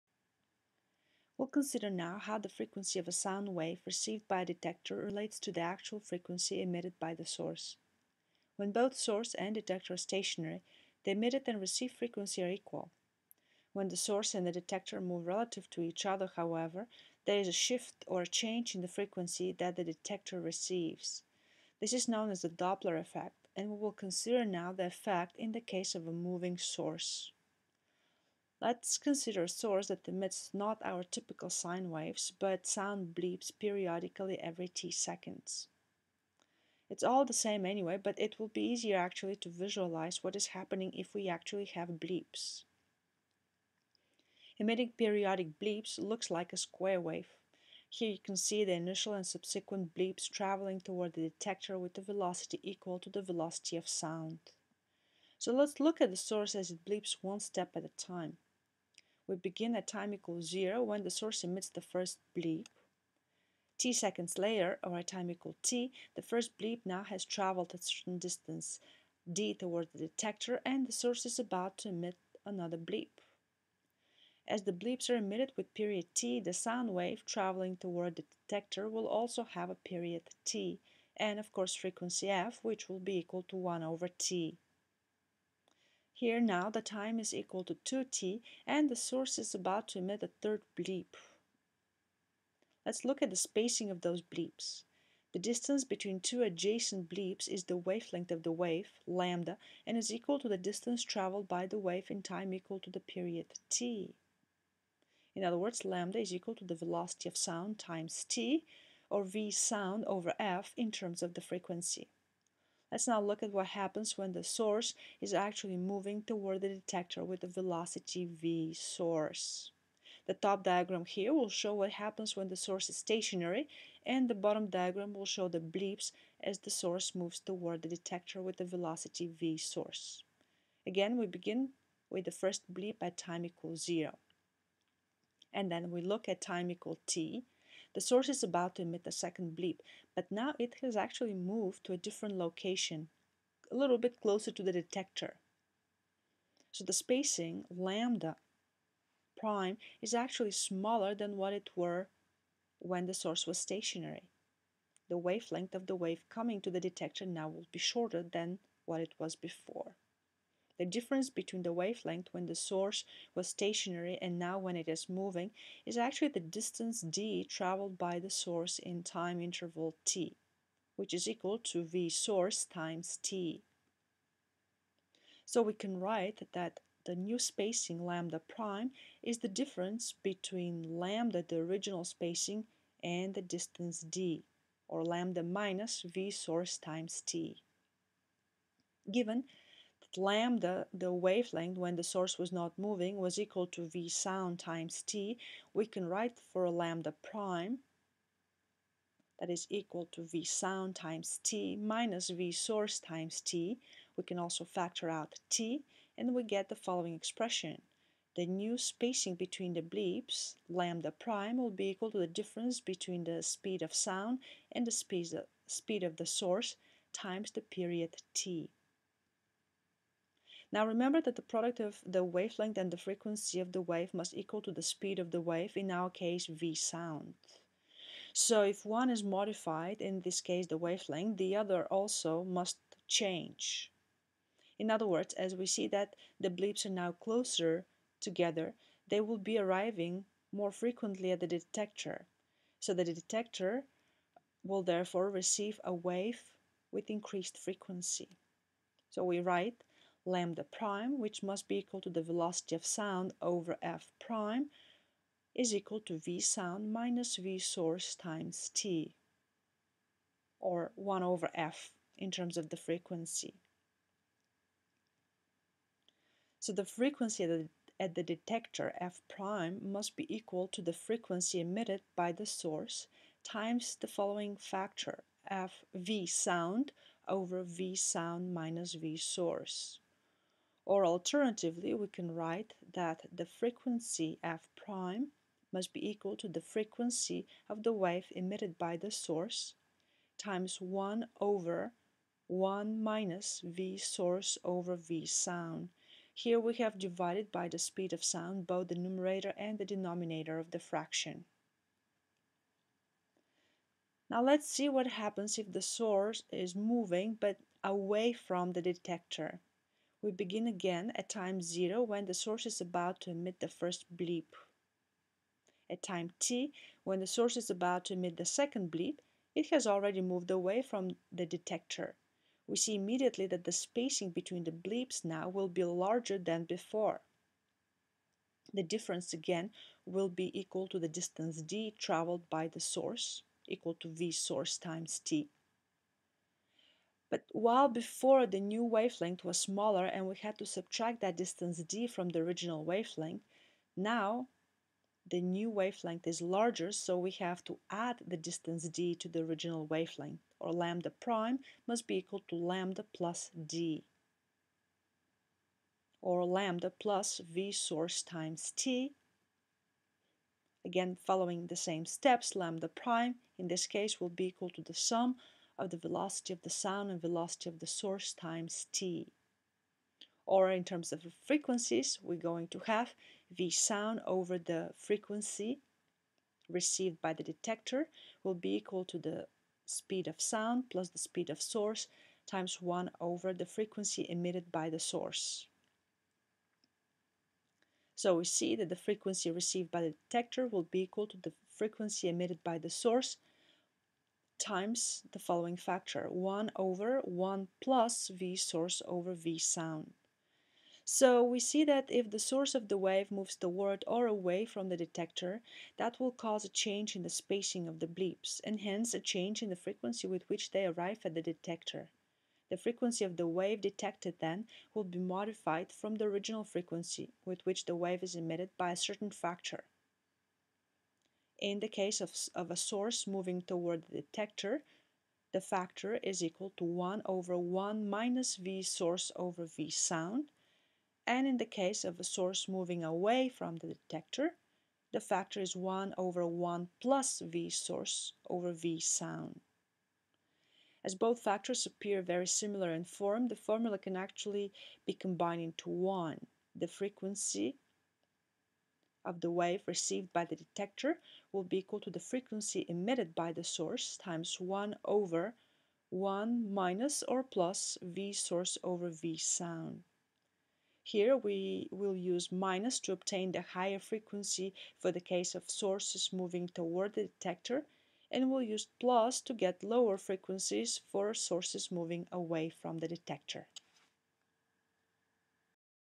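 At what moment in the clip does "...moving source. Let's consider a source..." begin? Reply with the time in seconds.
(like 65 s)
26 s.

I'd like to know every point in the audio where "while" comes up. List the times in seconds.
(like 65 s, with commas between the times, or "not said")
337 s.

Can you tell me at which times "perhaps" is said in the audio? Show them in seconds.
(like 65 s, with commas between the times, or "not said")
not said.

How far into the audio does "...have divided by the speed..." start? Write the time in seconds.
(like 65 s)
296 s.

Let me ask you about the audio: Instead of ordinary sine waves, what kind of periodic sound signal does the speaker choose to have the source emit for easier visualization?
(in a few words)
Sound bleeps.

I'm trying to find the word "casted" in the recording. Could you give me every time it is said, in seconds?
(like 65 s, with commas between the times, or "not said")
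not said.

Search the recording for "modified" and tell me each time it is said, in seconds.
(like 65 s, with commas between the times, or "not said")
229 s, 415 s.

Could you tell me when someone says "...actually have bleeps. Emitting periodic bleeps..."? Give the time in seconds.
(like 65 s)
41 s.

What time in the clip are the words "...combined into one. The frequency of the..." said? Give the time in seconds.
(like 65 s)
445 s.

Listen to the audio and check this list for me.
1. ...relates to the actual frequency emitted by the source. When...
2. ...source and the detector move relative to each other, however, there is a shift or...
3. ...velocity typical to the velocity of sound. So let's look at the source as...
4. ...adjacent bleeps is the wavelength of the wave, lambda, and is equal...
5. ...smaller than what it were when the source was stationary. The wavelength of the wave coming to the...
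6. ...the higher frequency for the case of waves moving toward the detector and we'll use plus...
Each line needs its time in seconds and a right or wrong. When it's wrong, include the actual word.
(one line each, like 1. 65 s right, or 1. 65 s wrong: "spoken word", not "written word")
1. 4 s right
2. 13 s right
3. 52 s wrong: "equal", not "typical"
4. 96 s right
5. 150 s right
6. 463 s wrong: "sources", not "waves".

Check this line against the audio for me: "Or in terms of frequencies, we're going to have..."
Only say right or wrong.
right.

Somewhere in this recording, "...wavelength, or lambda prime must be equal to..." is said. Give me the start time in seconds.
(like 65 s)
349 s.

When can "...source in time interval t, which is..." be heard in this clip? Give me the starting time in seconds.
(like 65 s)
168 s.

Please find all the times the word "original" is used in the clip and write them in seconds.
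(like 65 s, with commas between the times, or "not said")
181 s, 342 s, 349 s, 416 s.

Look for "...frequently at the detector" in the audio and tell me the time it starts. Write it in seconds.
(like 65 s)
240 s.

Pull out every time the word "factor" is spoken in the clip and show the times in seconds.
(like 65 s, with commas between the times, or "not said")
204 s, 274 s, 395 s, 419 s, 425 s, 435 s, 441 s.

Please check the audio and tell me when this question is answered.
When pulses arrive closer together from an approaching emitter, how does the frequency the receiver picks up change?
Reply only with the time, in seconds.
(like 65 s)
247 s.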